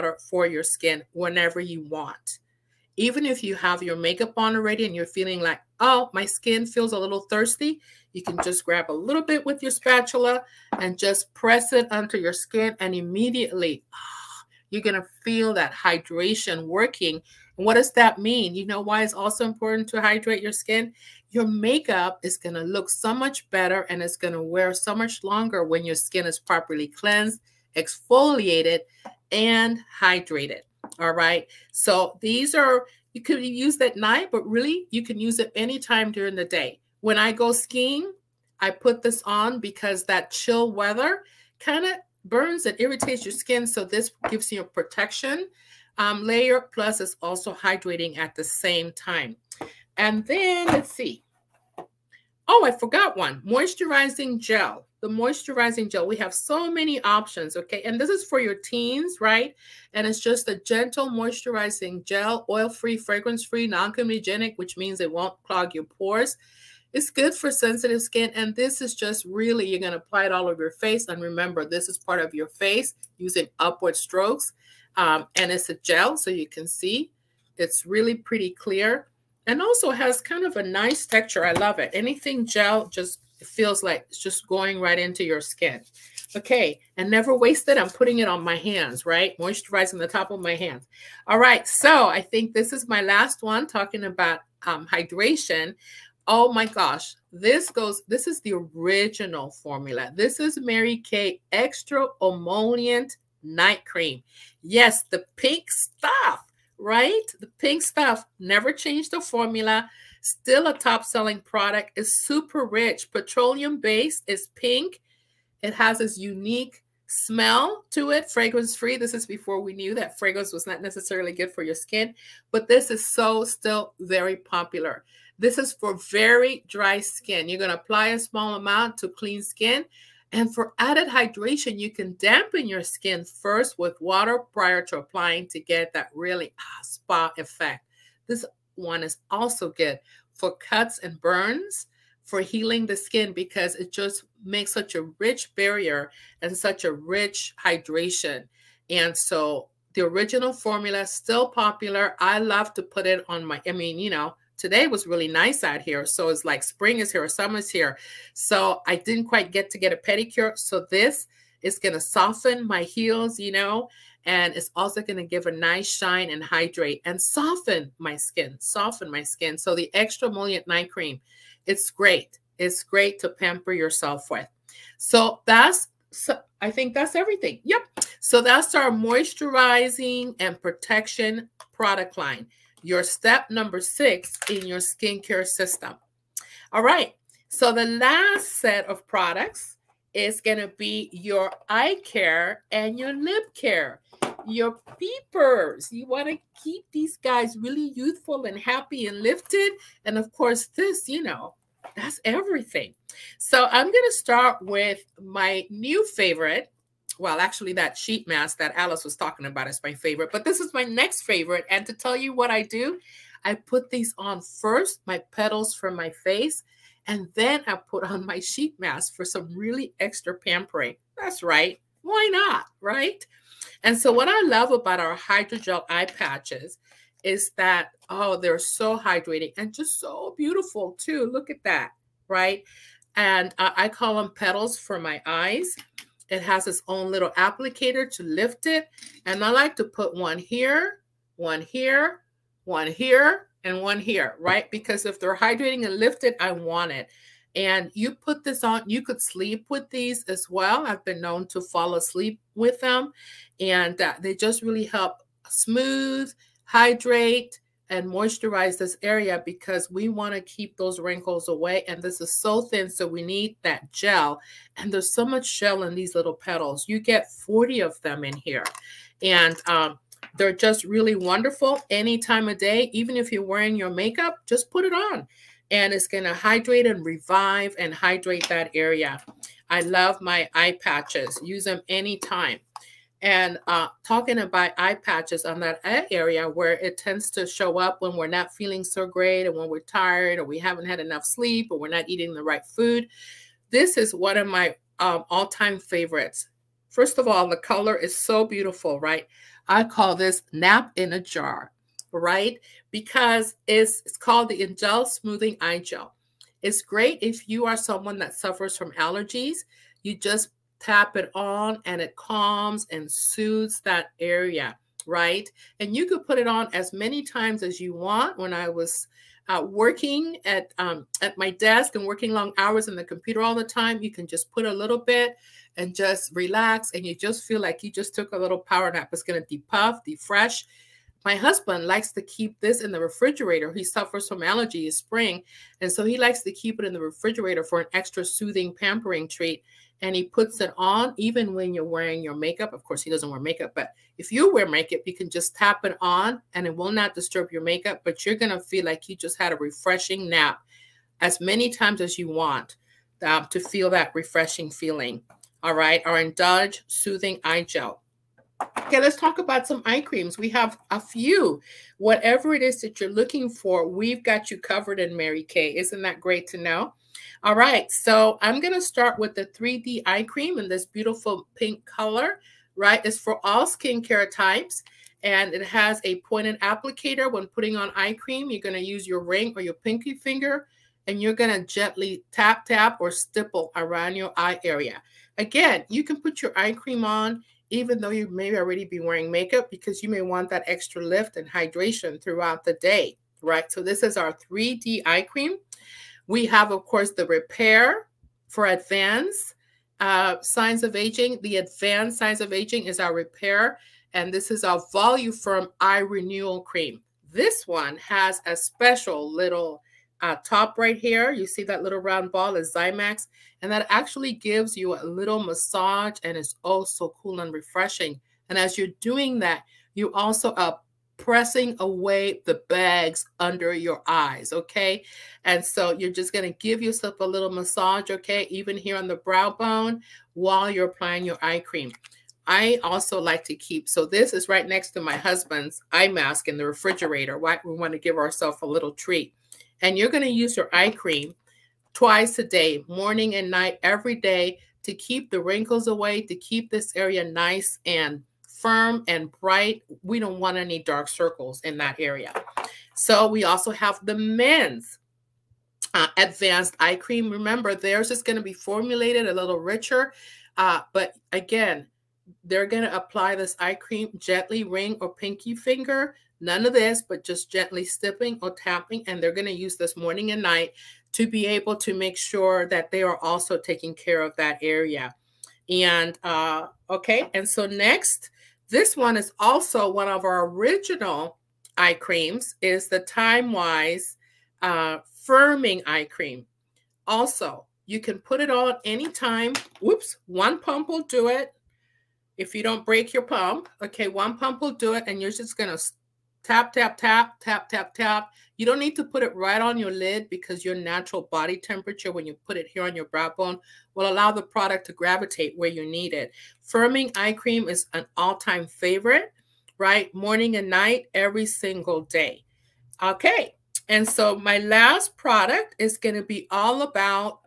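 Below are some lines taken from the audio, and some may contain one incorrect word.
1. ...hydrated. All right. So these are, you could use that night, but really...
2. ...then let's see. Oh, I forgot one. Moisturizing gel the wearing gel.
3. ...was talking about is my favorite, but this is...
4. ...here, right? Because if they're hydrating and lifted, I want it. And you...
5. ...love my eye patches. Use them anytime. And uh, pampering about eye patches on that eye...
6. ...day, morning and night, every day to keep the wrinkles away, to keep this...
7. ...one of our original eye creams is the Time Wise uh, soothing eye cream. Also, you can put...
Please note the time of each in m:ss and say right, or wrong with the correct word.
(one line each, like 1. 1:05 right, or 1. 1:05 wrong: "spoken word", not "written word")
1. 0:30 right
2. 0:50 wrong: "moisturizing", not "wearing"
3. 3:29 right
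4. 4:03 right
5. 4:39 wrong: "talking", not "pampering"
6. 7:22 right
7. 7:59 wrong: "firming", not "soothing".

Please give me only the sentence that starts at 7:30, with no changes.
We don't want any dark circles in that area.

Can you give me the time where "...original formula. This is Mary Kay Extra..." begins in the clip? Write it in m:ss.
1:38.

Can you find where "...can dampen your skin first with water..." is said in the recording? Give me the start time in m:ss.
2:11.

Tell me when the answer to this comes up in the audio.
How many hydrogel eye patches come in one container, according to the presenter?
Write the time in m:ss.
4:27.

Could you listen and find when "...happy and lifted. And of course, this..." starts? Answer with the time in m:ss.
3:18.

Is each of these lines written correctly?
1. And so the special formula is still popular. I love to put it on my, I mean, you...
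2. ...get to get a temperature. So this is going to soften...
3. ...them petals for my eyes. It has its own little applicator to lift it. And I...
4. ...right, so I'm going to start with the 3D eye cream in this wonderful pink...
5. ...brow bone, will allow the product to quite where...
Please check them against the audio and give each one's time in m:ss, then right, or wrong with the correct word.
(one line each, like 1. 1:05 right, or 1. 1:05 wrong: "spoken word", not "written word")
1. 2:28 wrong: "original", not "special"
2. 2:39 wrong: "pedicure", not "temperature"
3. 3:54 right
4. 6:07 wrong: "beautiful", not "wonderful"
5. 8:23 wrong: "gravitate", not "quite".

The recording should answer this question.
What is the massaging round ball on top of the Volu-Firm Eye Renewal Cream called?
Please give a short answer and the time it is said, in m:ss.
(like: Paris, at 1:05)
Zymax, at 6:52.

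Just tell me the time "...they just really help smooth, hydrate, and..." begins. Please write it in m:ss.
4:14.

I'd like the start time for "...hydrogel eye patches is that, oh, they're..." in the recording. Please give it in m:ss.
3:45.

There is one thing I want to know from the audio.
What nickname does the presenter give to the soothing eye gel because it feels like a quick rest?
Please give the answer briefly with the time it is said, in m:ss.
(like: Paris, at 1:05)
nap in a jar, at 5:00.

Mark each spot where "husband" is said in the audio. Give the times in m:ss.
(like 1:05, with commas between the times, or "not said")
5:31, 7:15.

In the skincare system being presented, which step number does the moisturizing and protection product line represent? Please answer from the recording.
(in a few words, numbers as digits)
6.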